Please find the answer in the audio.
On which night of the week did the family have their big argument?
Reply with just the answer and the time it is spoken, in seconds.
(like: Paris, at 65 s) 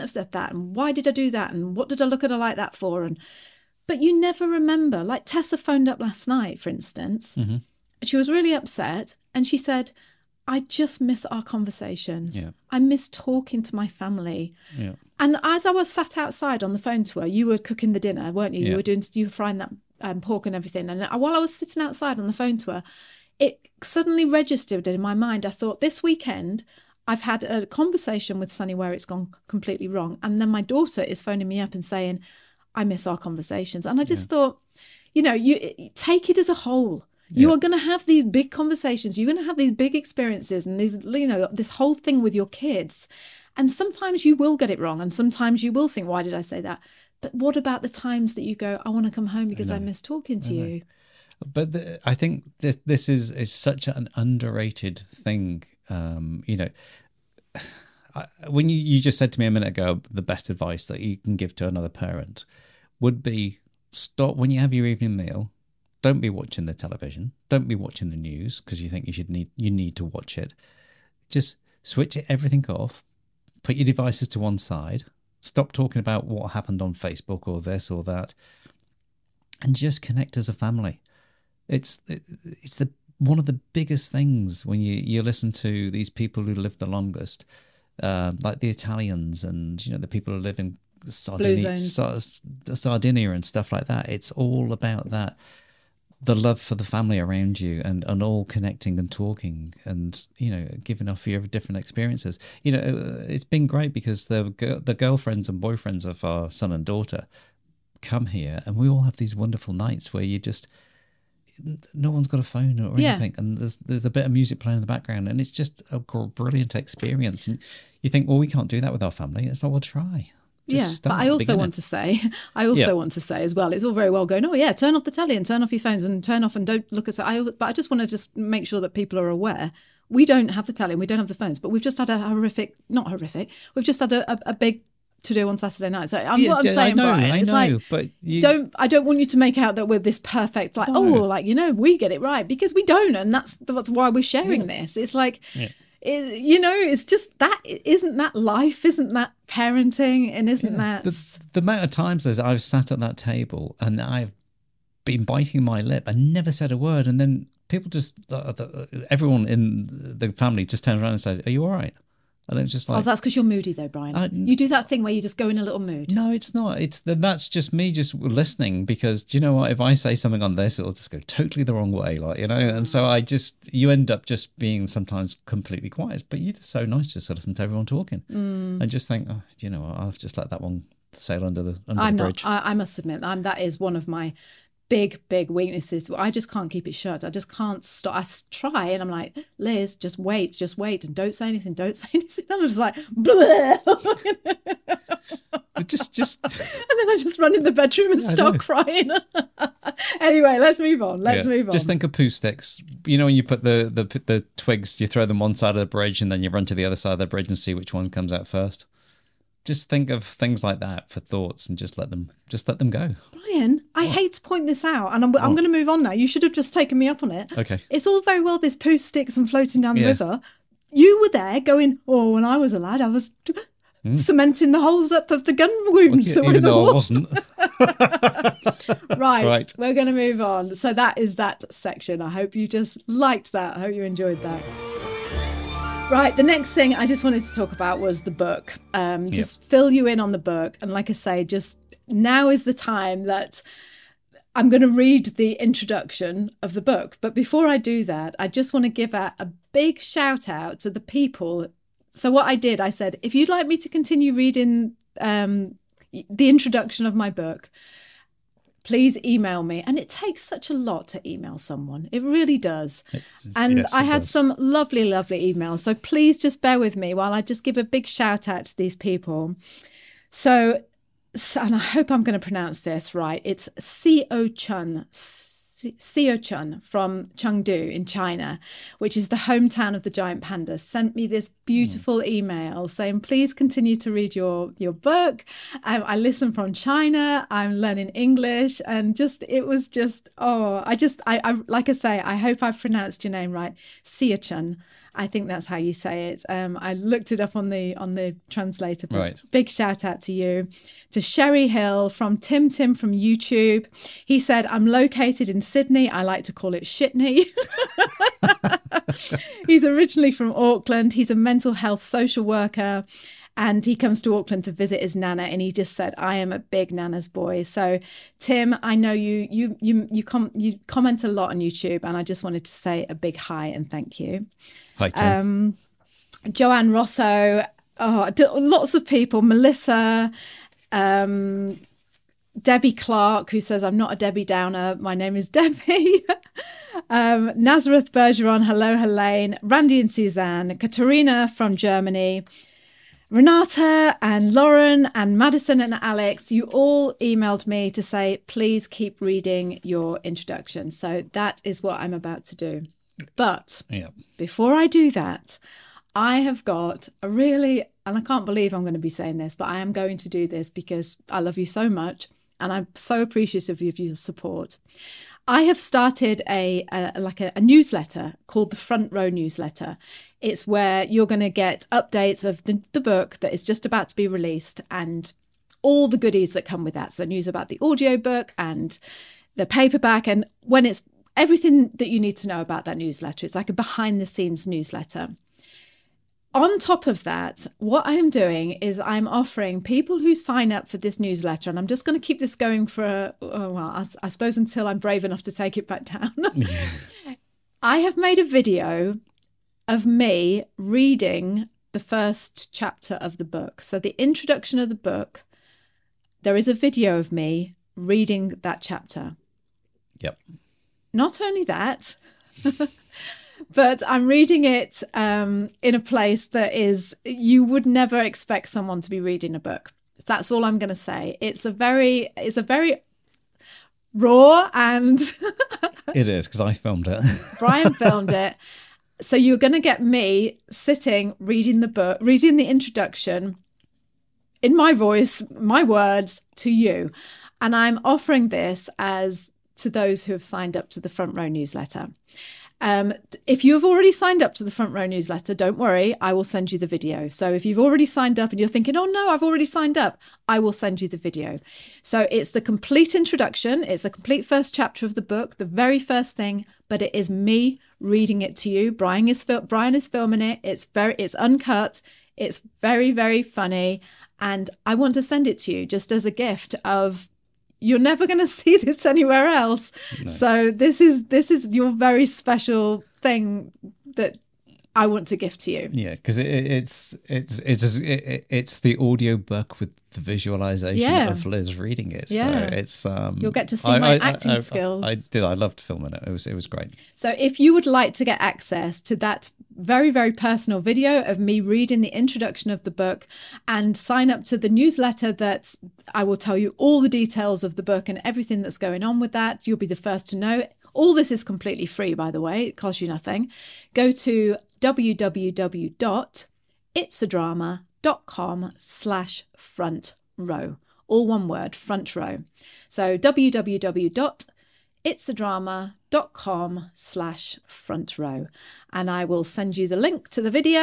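Saturday, at 135 s.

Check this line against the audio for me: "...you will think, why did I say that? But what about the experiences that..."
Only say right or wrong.
wrong.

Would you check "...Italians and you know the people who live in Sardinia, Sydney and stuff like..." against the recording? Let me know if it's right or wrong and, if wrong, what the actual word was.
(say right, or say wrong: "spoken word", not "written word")
wrong: "Sardinia", not "Sydney".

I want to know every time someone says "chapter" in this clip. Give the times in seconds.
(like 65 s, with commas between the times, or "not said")
402 s, 408 s, 454 s.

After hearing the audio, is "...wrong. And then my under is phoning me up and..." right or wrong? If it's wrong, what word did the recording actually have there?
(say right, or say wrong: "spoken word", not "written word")
wrong: "daughter", not "under".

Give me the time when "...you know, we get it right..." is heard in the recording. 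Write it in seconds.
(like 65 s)
141 s.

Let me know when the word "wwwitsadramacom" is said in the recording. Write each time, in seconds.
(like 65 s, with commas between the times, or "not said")
504 s, 513 s.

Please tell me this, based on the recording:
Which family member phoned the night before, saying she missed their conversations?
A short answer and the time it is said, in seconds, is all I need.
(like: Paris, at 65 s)
Tessa, at 5 s.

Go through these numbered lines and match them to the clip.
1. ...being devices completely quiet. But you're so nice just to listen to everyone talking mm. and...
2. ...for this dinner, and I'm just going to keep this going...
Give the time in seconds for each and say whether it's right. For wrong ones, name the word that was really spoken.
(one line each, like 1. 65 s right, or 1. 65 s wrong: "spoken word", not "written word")
1. 174 s wrong: "sometimes", not "devices"
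2. 390 s wrong: "newsletter", not "dinner".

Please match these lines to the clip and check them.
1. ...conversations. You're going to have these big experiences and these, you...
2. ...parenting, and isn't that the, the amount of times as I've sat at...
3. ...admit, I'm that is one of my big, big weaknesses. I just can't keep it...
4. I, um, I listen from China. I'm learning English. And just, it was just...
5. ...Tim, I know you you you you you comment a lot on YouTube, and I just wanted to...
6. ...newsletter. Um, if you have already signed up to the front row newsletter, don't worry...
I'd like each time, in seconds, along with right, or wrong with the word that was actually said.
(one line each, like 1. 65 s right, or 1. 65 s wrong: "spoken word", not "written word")
1. 38 s right
2. 149 s right
3. 182 s right
4. 285 s right
5. 318 s right
6. 441 s right.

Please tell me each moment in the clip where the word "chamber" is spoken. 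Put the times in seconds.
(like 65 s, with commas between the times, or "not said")
not said.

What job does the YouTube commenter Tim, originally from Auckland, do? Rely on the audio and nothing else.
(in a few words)
Mental health social worker.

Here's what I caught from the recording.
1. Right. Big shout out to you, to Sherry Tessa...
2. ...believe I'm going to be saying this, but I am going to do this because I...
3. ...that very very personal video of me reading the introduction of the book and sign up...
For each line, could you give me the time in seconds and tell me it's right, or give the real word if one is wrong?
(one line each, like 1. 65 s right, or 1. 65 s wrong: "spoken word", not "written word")
1. 299 s wrong: "Hill", not "Tessa"
2. 358 s right
3. 489 s right.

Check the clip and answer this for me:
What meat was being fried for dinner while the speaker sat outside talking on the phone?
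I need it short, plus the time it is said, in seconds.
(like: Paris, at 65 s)
Pork, at 20 s.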